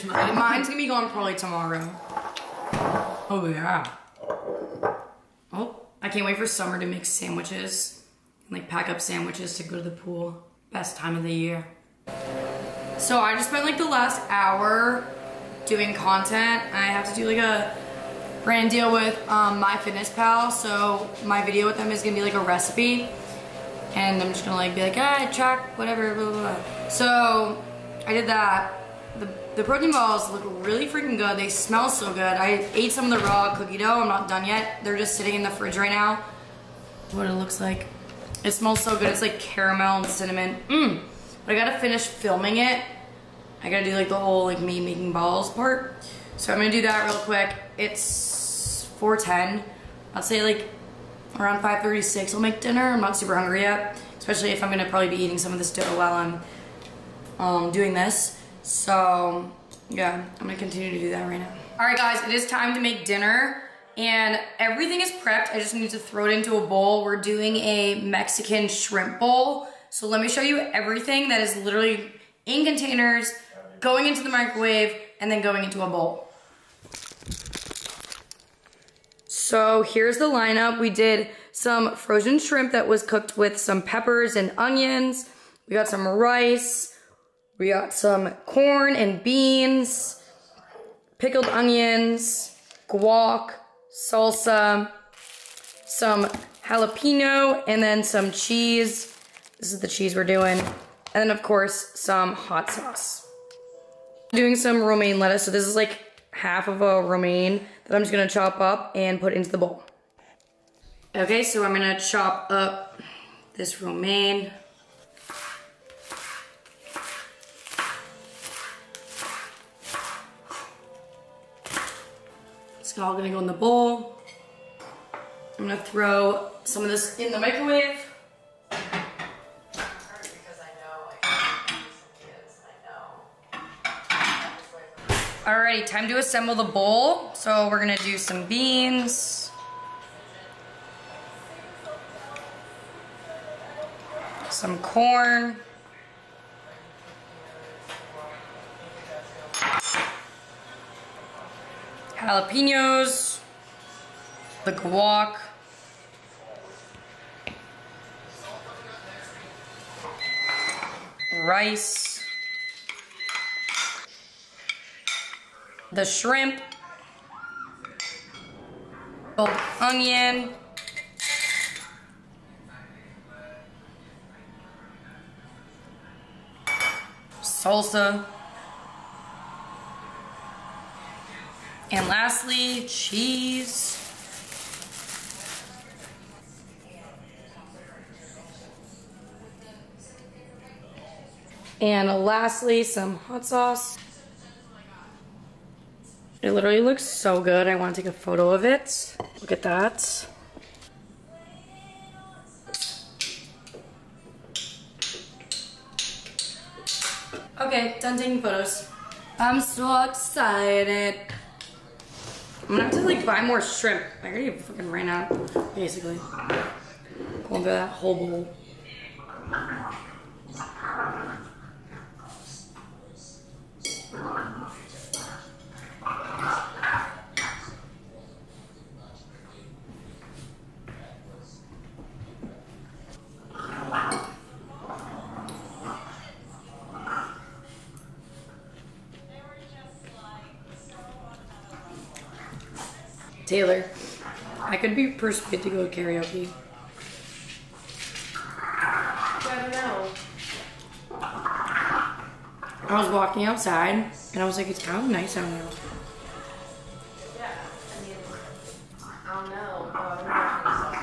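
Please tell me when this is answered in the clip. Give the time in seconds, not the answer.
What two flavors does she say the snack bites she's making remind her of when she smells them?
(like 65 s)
39 s.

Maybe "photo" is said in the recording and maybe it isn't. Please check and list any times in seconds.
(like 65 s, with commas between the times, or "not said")
198 s, 208 s.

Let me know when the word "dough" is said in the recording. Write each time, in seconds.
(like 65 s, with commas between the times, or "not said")
33 s, 55 s.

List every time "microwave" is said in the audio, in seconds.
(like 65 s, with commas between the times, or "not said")
74 s, 127 s.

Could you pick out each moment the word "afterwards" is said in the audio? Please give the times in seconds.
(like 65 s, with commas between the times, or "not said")
not said.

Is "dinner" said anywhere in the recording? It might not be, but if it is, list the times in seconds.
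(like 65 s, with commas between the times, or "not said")
52 s, 63 s.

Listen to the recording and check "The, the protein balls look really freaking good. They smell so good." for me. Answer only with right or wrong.
right.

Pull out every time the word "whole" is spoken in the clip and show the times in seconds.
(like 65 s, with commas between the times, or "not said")
44 s, 217 s.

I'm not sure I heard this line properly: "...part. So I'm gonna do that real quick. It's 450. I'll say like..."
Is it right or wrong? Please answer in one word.
wrong.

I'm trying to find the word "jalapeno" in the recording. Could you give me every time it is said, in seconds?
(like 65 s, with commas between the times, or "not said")
96 s, 152 s.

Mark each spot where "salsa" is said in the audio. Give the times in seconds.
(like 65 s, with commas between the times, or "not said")
94 s, 177 s.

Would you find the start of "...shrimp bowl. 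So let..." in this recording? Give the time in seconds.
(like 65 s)
68 s.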